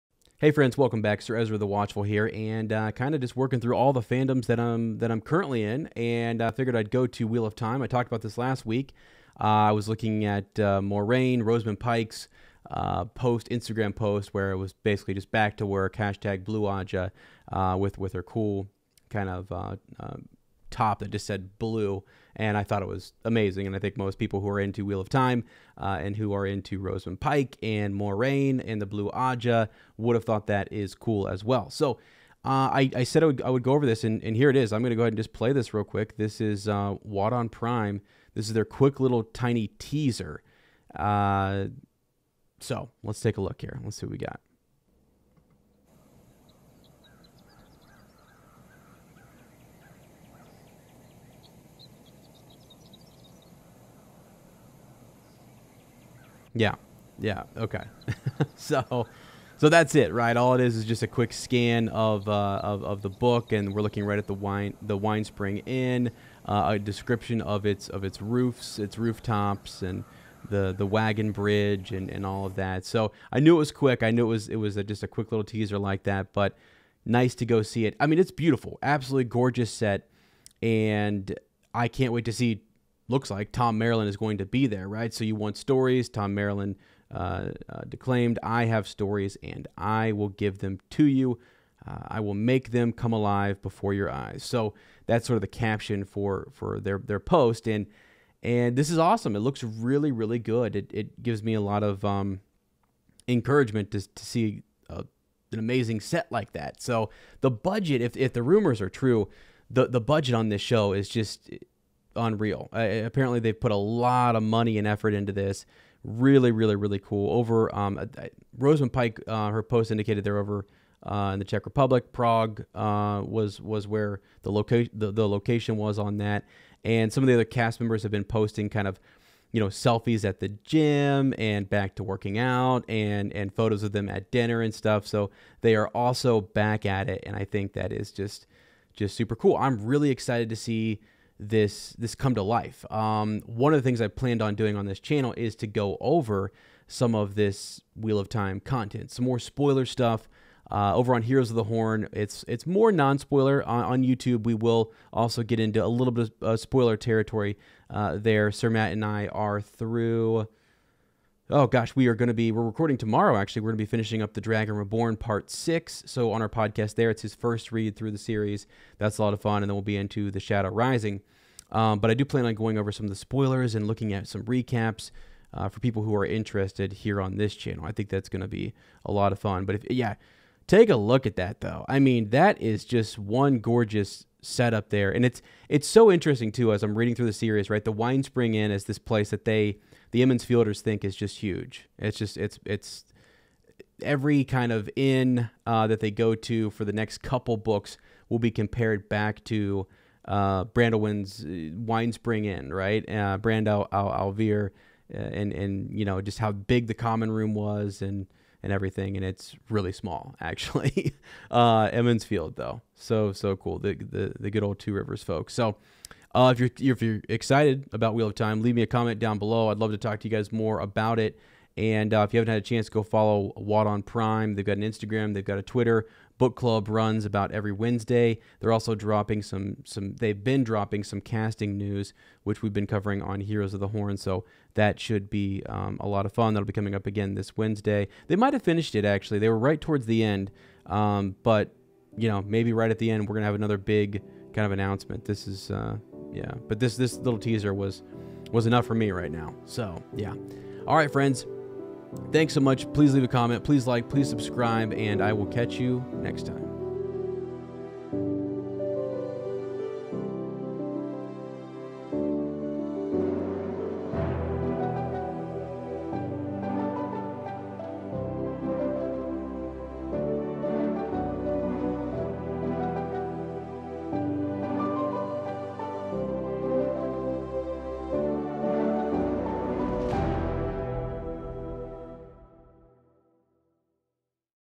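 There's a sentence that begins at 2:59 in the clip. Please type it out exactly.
But if, yeah, take a look at that though.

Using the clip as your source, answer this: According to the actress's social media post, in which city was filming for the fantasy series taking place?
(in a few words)
Prague.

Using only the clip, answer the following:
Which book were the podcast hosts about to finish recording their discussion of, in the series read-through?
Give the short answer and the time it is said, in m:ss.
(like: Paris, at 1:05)
The Dragon Reborn, at 2:44.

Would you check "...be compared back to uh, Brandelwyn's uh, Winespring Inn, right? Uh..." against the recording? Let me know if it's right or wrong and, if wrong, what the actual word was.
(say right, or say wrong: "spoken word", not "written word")
right.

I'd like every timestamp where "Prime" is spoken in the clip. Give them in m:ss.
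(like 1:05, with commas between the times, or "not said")
0:37, 3:44.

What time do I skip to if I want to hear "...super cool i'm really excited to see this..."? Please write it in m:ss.
2:19.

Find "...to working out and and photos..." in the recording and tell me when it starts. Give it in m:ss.
2:11.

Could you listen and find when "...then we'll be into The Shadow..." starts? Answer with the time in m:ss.
2:49.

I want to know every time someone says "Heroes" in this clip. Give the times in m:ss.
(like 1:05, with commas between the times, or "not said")
2:31, 3:53.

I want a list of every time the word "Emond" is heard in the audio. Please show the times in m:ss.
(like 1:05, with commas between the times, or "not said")
3:10, 3:31.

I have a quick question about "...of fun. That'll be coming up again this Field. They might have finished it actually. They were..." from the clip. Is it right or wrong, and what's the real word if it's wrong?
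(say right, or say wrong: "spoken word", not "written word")
wrong: "Wednesday", not "Field".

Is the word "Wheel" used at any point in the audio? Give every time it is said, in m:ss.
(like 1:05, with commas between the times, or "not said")
0:07, 0:24, 2:27, 3:38.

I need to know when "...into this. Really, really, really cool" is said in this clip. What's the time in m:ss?
1:55.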